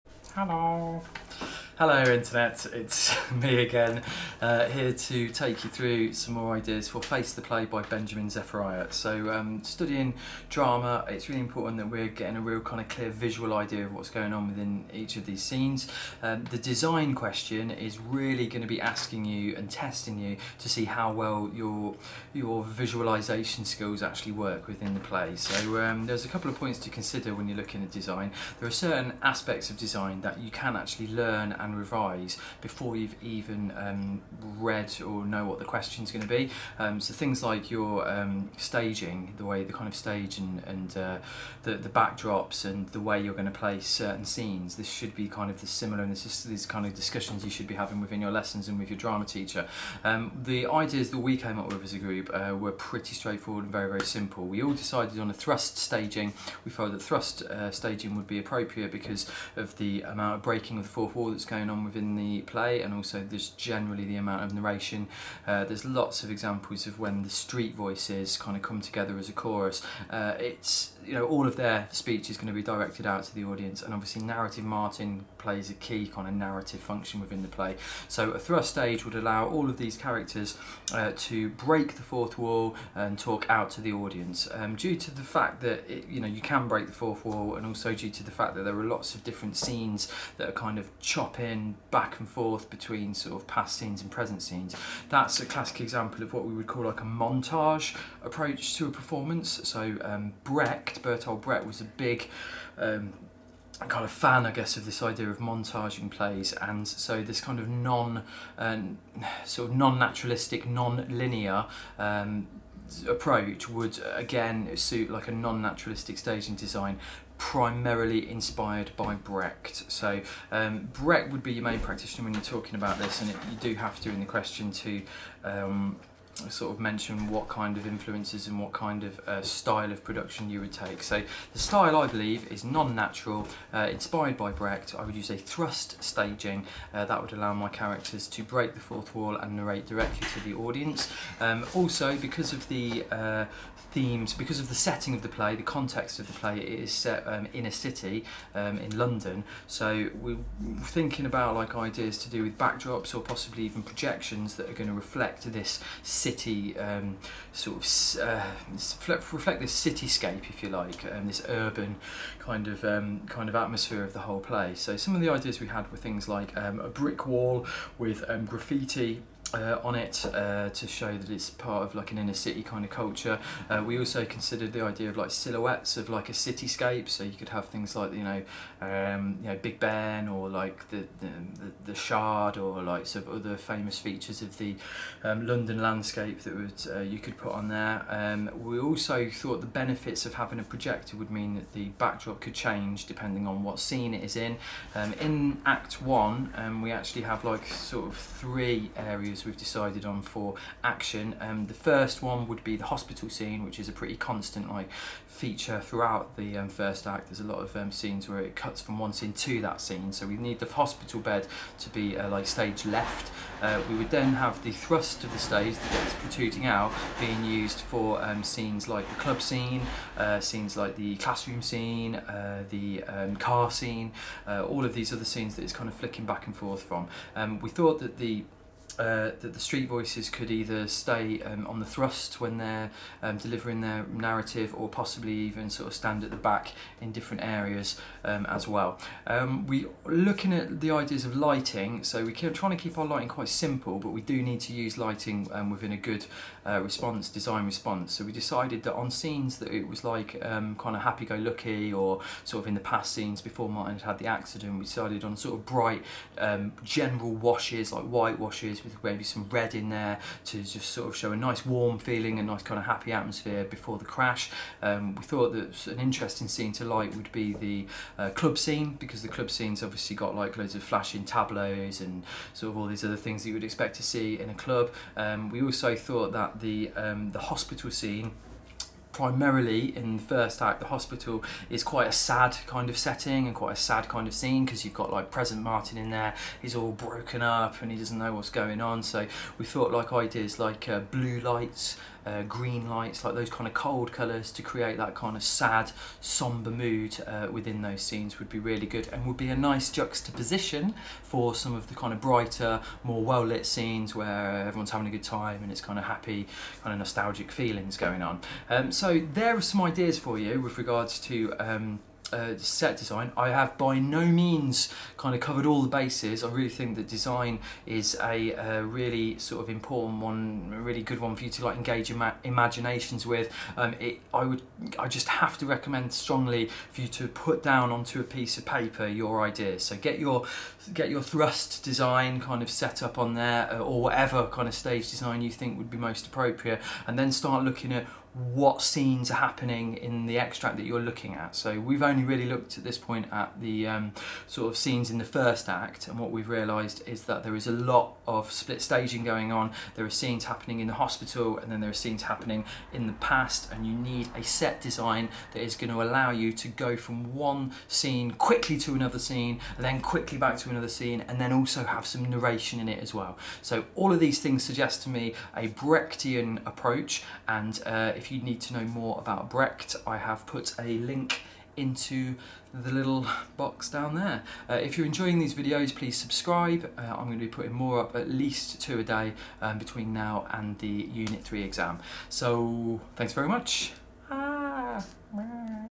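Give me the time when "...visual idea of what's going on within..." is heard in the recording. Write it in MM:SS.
00:13.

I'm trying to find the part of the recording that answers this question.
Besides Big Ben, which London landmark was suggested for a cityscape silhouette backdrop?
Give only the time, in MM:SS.
03:01.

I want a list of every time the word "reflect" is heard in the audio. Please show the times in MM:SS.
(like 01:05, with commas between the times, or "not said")
02:34, 02:39.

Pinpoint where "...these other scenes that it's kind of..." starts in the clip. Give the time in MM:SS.
03:44.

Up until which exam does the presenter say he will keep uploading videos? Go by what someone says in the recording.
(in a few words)
Unit 3.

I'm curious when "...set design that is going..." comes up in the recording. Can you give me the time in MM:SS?
05:54.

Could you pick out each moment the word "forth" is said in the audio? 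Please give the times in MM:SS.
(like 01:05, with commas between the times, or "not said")
01:32, 03:46.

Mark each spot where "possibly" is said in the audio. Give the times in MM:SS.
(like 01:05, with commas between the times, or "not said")
02:33, 03:54.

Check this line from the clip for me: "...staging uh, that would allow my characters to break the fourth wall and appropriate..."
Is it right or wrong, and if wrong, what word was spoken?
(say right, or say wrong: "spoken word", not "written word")
wrong: "narrate", not "appropriate".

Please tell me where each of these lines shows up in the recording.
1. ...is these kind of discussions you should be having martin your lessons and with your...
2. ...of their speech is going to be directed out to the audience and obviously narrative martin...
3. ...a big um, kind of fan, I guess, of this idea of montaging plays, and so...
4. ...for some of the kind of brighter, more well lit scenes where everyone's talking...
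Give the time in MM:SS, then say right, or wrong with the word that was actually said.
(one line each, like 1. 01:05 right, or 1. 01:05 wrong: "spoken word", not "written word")
1. 00:46 wrong: "within", not "martin"
2. 01:11 right
3. 01:41 right
4. 05:01 wrong: "having", not "talking".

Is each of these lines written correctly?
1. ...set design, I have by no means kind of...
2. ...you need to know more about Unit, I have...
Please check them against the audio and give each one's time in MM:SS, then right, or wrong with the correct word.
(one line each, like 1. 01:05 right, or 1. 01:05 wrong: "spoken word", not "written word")
1. 05:12 right
2. 06:08 wrong: "Brecht", not "Unit".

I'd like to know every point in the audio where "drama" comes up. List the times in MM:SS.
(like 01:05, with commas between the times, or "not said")
00:10, 00:48.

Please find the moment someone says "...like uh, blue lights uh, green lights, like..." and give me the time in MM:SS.
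04:50.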